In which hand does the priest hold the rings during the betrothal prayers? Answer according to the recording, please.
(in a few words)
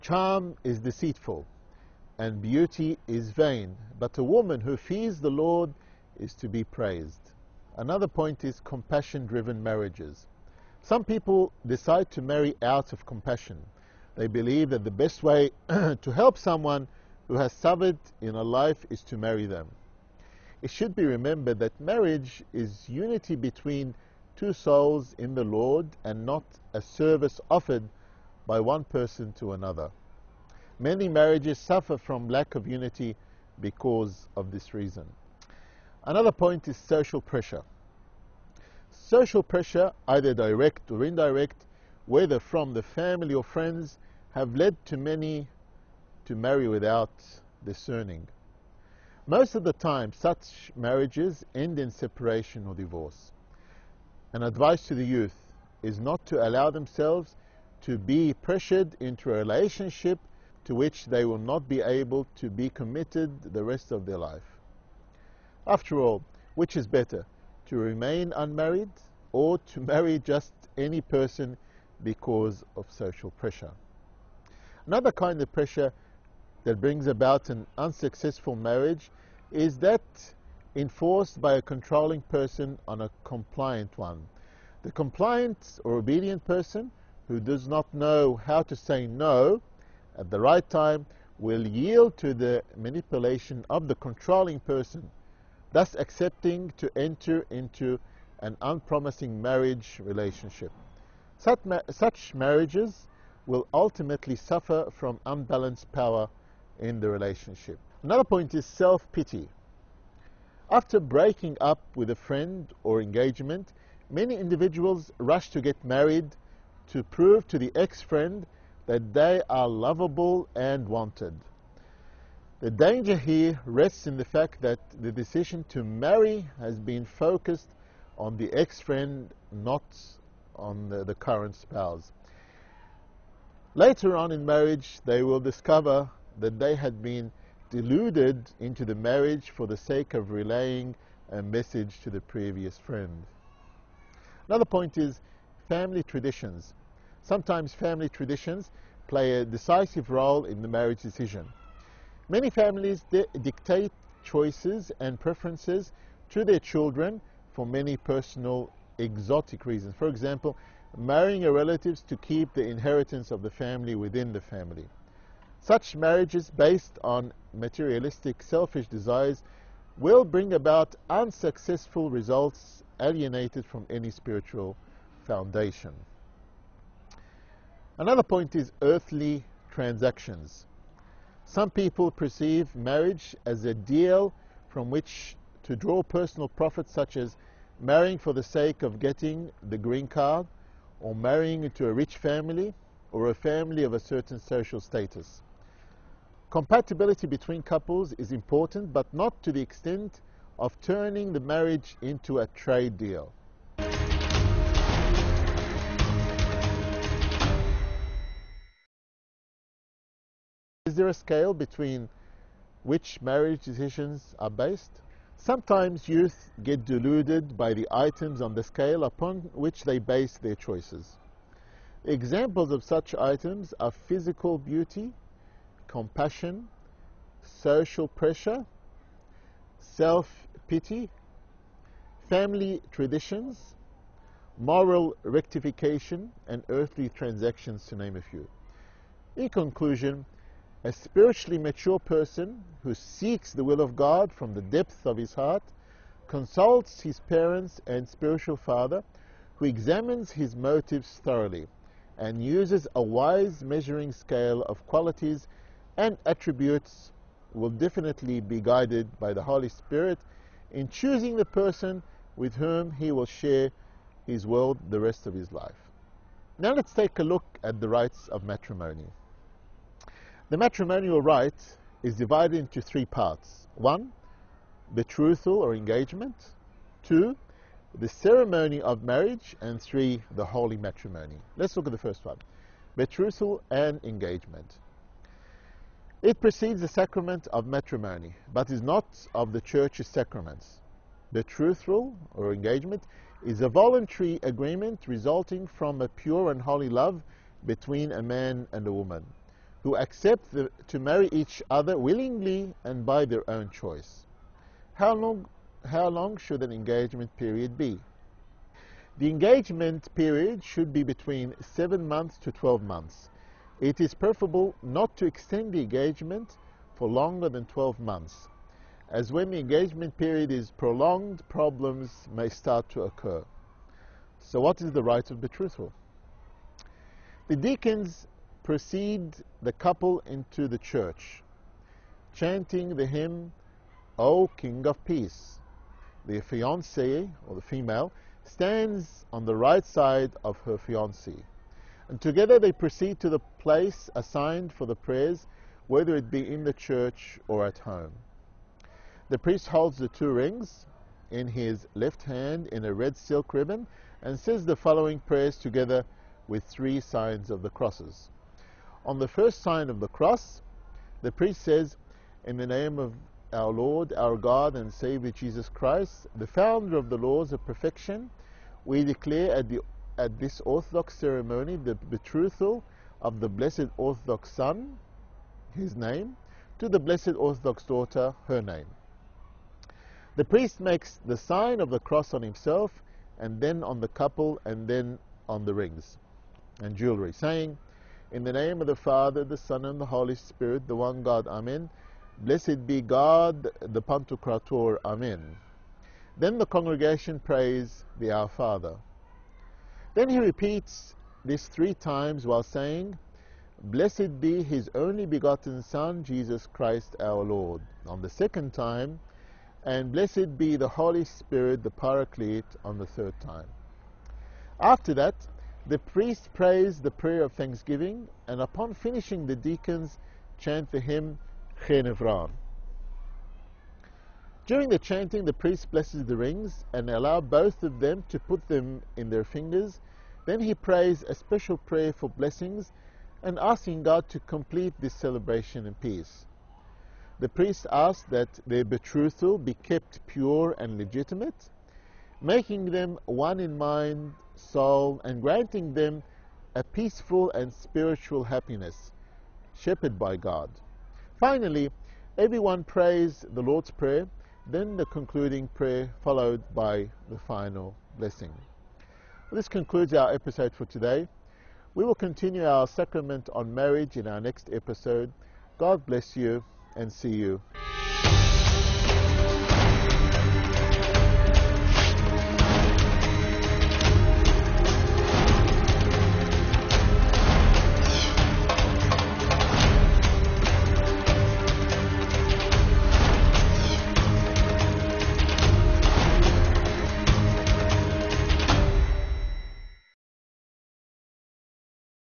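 left hand.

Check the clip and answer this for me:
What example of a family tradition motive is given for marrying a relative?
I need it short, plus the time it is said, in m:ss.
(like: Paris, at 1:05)
keep the inheritance, at 2:42.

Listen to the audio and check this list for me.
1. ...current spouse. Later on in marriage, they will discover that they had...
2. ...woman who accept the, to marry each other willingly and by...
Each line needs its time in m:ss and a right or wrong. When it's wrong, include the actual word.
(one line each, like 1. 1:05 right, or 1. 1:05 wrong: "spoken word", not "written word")
1. 2:11 right
2. 4:58 right.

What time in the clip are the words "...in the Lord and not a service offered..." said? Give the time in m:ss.
0:25.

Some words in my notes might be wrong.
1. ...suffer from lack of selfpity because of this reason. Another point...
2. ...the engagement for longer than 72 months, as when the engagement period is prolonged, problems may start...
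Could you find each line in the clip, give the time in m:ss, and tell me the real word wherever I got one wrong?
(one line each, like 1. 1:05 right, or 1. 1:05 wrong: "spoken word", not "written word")
1. 0:31 wrong: "unity", not "selfpity"
2. 5:15 wrong: "12", not "72".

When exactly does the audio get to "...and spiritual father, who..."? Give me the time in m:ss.
4:07.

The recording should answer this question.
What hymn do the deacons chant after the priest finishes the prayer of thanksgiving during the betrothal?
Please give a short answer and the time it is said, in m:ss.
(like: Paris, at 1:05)
Chenevrar, at 7:01.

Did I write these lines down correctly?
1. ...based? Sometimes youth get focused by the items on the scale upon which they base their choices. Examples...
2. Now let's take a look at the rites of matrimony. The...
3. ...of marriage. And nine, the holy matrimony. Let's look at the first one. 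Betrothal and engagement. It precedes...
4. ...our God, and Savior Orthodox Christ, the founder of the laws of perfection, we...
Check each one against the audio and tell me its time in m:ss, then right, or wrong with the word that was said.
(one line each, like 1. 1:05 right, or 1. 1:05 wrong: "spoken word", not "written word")
1. 3:34 wrong: "deluded", not "focused"
2. 4:26 right
3. 4:38 wrong: "three", not "nine"
4. 6:04 wrong: "Jesus", not "Orthodox".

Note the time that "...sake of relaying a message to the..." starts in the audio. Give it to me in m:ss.
2:19.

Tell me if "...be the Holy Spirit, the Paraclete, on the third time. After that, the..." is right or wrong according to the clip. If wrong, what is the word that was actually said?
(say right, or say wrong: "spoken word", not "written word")
right.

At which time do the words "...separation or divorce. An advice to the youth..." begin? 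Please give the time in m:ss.
0:51.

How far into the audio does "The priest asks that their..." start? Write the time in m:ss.
7:17.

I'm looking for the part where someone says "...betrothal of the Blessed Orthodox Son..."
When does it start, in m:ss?
6:11.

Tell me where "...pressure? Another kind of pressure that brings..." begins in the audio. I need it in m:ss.
1:13.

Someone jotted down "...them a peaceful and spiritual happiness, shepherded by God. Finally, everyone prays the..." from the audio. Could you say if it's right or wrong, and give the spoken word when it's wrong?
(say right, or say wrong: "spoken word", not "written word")
right.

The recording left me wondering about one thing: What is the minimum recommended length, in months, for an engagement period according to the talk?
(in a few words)
7.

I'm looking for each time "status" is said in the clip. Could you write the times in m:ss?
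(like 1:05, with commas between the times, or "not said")
3:14.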